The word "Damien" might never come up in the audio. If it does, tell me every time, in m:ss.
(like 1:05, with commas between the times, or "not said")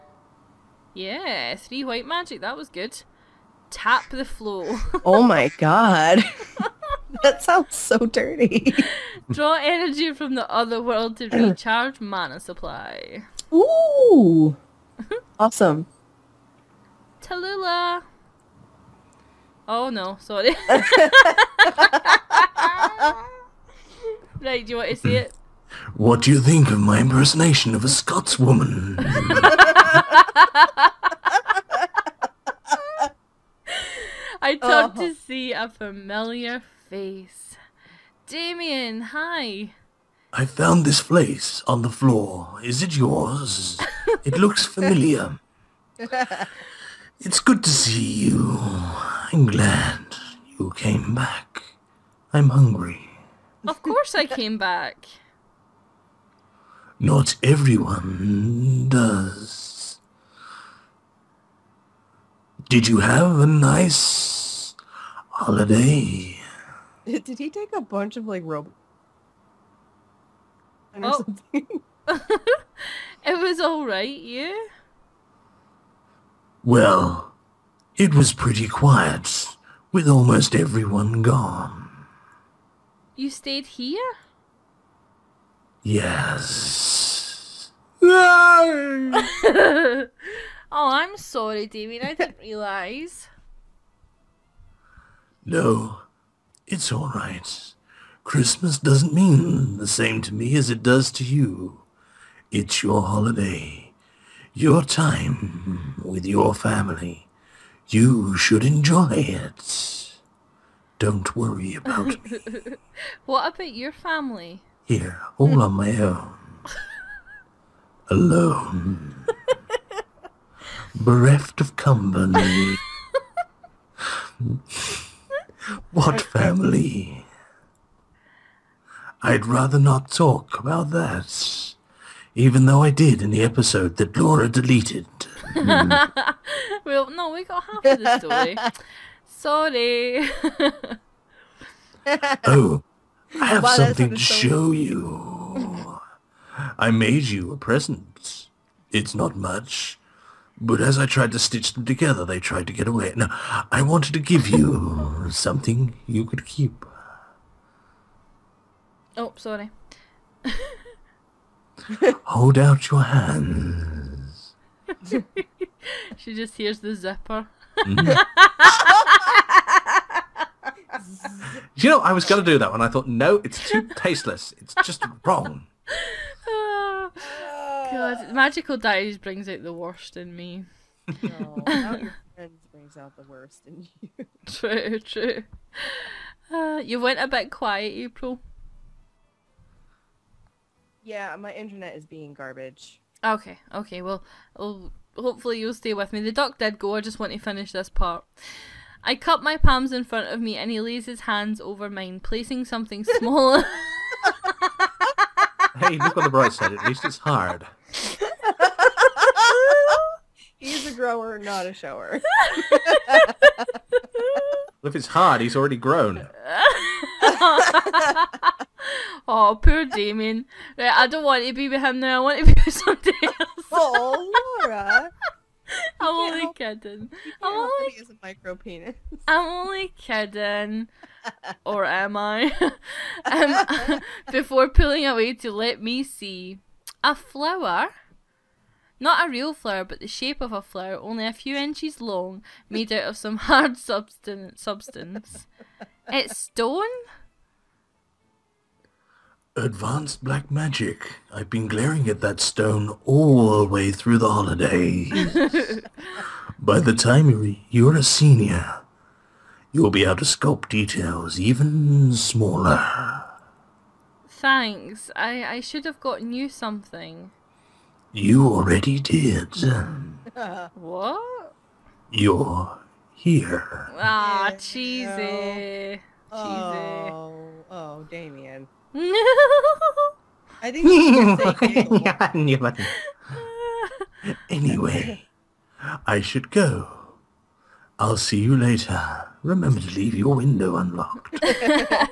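0:38, 1:31, 3:39, 4:38.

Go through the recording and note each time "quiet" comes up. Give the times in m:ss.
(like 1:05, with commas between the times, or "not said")
1:18, 3:07.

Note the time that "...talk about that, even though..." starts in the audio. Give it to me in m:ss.
2:10.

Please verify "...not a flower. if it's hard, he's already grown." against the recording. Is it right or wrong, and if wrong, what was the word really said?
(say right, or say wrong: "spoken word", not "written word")
wrong: "shower", not "flower".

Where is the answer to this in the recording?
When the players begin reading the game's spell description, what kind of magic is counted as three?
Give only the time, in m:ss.
0:01.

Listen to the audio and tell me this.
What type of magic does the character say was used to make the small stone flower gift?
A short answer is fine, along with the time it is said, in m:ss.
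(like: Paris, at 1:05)
Advanced black magic, at 4:09.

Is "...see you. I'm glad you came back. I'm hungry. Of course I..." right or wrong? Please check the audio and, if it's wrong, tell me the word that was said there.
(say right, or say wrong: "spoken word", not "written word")
right.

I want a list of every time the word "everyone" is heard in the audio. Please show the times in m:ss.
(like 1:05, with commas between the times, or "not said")
0:57, 1:20.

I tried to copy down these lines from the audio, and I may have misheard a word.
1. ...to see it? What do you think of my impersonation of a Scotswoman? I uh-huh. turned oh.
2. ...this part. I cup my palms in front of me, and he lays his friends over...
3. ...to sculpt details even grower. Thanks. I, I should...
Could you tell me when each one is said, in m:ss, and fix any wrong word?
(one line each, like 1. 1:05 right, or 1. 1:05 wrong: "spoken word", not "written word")
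1. 0:24 right
2. 3:17 wrong: "hands", not "friends"
3. 4:20 wrong: "smaller", not "grower".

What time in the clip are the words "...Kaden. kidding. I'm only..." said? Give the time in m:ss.
3:46.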